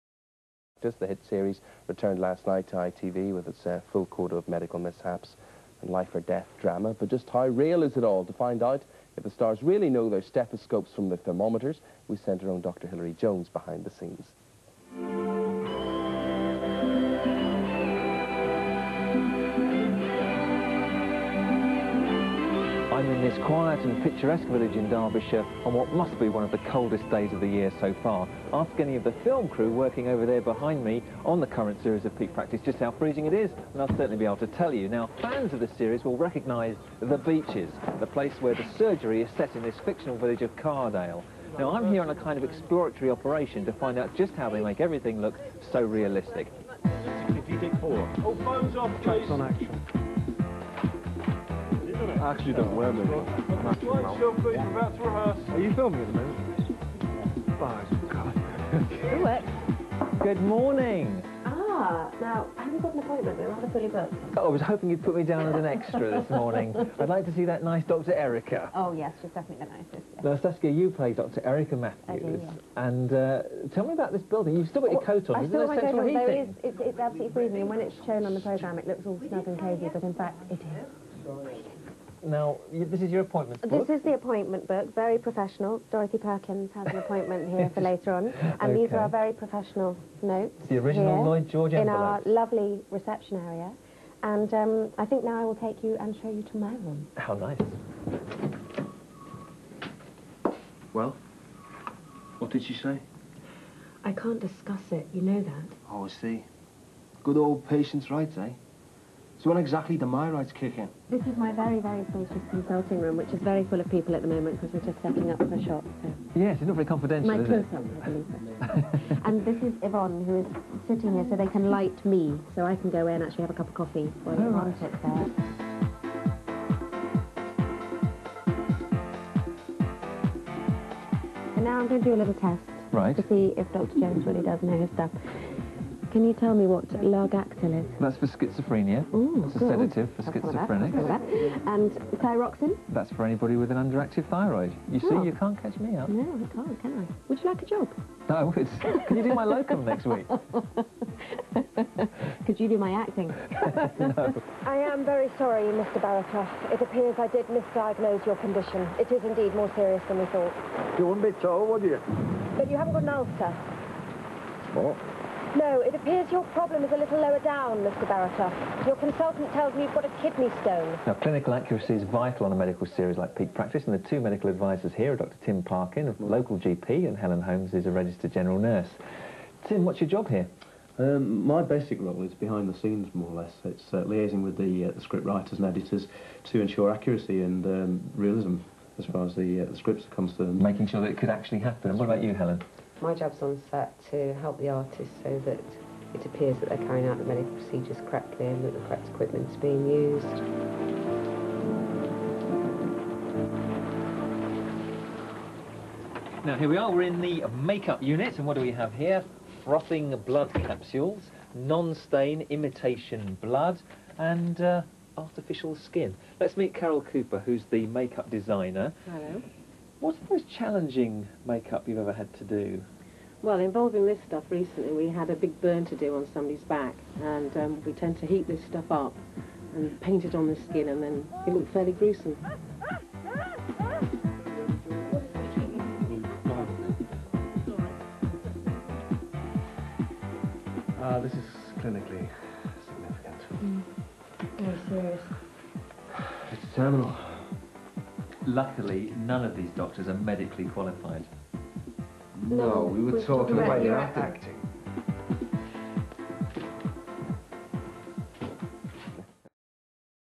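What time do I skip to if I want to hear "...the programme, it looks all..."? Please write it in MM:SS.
01:18.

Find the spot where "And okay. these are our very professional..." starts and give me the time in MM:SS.
01:28.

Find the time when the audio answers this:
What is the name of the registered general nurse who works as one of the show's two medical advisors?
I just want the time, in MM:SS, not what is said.
02:57.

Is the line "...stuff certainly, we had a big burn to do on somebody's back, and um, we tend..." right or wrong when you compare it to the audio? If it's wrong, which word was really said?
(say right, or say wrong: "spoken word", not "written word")
wrong: "recently", not "certainly".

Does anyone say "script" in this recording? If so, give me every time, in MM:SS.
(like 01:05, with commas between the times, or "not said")
03:05, 03:09.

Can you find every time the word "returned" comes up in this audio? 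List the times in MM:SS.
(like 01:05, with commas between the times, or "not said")
00:01.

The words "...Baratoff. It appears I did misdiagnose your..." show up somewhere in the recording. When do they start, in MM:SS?
02:36.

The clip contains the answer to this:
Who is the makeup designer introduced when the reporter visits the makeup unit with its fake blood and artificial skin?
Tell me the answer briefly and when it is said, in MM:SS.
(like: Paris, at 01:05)
Carol Cooper, at 03:36.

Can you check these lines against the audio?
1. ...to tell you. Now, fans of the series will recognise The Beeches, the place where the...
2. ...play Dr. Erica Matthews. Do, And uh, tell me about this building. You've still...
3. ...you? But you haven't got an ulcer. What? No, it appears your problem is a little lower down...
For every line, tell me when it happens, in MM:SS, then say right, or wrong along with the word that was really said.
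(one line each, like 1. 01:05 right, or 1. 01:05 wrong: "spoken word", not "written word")
1. 00:34 right
2. 01:10 right
3. 02:41 right.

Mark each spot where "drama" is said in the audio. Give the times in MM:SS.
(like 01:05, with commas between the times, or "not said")
00:06.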